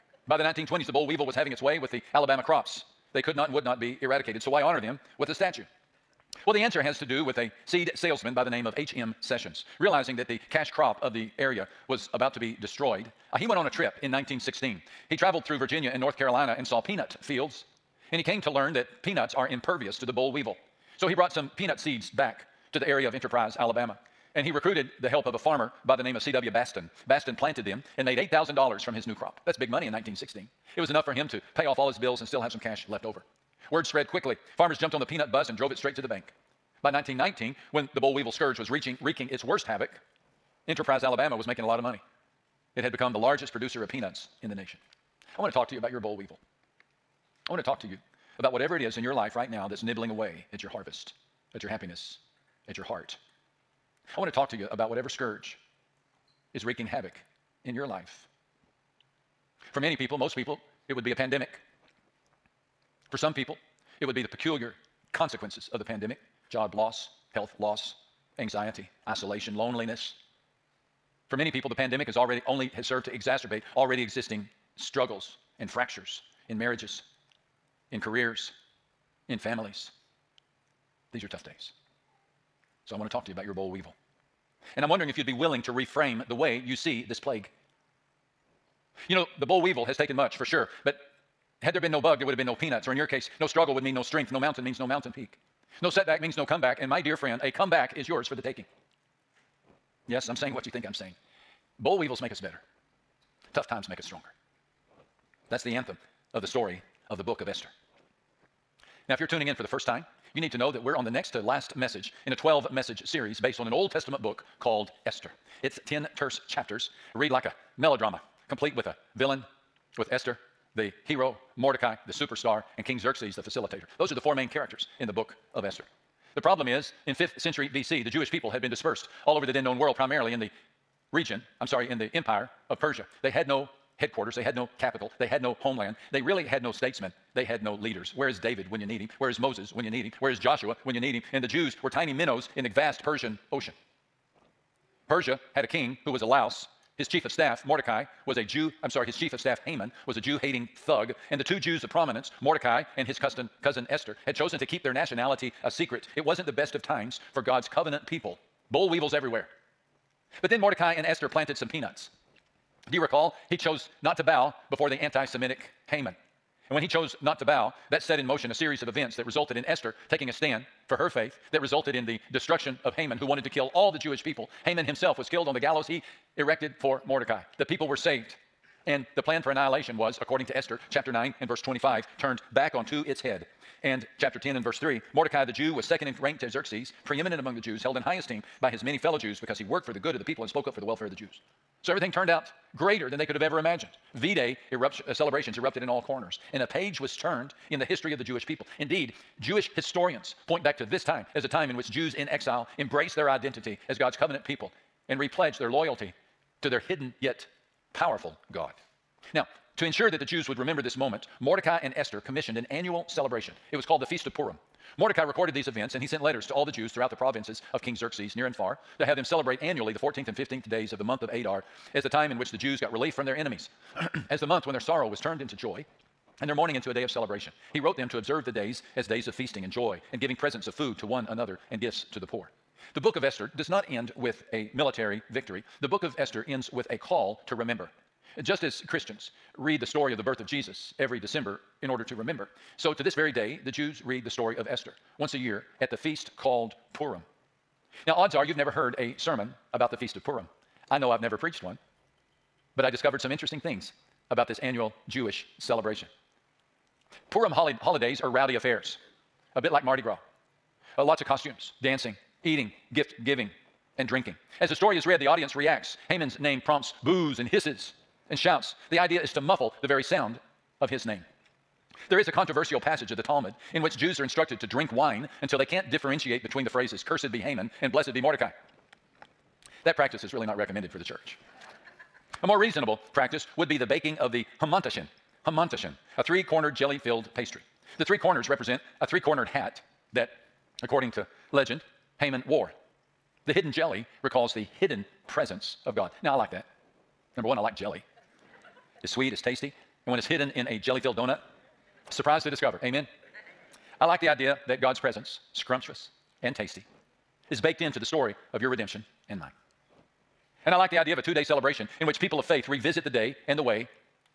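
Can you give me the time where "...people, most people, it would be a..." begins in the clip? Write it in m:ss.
0:59.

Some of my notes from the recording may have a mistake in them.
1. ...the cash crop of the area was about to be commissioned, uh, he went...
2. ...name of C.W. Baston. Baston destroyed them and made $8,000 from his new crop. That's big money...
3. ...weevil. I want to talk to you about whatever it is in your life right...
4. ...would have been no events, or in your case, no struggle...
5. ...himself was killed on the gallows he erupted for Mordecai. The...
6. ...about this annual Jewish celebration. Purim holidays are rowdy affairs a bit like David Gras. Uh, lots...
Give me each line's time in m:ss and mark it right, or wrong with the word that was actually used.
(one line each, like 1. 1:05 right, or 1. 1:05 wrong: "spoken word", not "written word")
1. 0:10 wrong: "destroyed", not "commissioned"
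2. 0:26 wrong: "planted", not "destroyed"
3. 0:46 right
4. 1:32 wrong: "peanuts", not "events"
5. 2:54 wrong: "erected", not "erupted"
6. 4:14 wrong: "Mardi", not "David".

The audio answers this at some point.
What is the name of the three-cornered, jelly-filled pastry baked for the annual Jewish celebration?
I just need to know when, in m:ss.
4:45.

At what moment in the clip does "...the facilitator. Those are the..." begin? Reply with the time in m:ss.
2:03.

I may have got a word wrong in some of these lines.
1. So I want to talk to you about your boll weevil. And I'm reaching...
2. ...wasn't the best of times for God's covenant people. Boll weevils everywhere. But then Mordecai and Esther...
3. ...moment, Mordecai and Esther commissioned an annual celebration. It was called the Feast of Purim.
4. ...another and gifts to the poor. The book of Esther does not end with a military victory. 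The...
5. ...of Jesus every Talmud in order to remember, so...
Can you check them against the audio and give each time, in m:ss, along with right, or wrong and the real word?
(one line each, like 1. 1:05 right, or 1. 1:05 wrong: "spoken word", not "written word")
1. 1:22 wrong: "wondering", not "reaching"
2. 2:36 right
3. 3:30 right
4. 3:51 right
5. 4:00 wrong: "December", not "Talmud".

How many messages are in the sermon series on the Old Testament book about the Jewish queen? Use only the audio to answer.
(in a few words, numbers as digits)
12.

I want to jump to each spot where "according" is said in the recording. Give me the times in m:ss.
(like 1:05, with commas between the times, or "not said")
3:00, 4:50.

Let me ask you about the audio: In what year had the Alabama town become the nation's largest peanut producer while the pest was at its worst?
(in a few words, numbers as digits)
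1919.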